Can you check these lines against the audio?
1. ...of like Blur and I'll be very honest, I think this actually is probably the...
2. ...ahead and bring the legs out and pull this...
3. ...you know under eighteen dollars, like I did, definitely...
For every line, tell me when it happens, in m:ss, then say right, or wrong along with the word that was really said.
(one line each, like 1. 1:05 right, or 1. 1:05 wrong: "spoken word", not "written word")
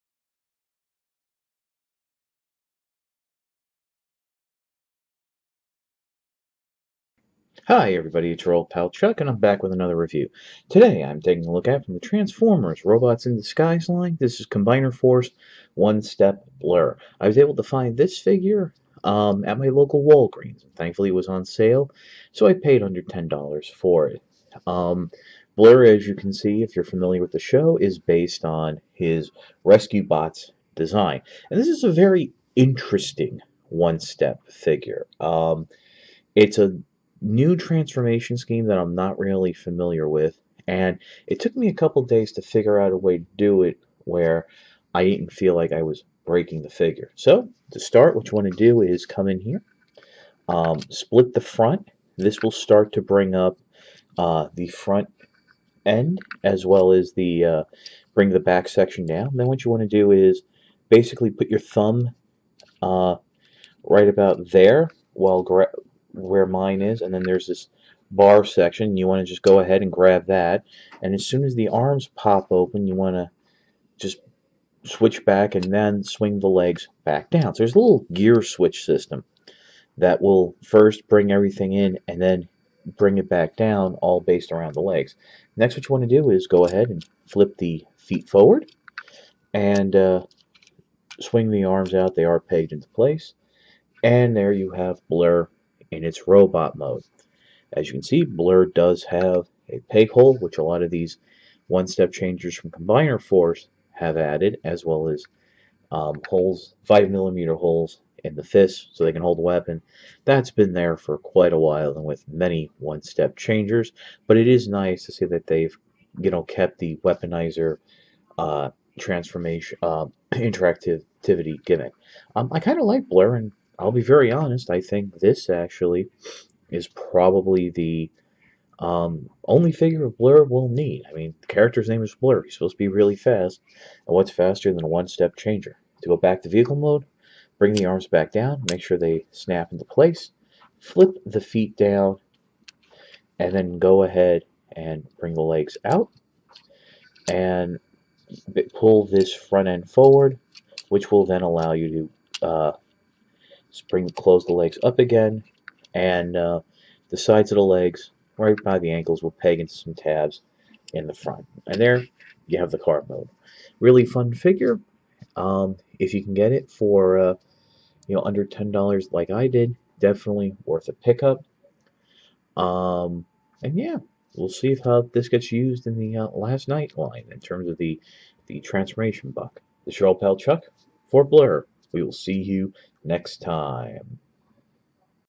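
1. 2:02 right
2. 2:24 right
3. 2:48 wrong: "ten", not "eighteen".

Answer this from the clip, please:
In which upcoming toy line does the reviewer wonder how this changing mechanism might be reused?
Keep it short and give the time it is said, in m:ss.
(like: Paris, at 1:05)
Last Knight, at 2:56.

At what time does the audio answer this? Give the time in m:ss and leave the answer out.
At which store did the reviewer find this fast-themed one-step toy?
0:20.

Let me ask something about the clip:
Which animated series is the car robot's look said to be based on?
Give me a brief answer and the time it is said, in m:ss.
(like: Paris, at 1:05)
Rescue Bots, at 0:29.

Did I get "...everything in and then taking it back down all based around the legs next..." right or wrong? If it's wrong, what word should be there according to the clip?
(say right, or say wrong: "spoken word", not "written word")
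wrong: "bring", not "taking".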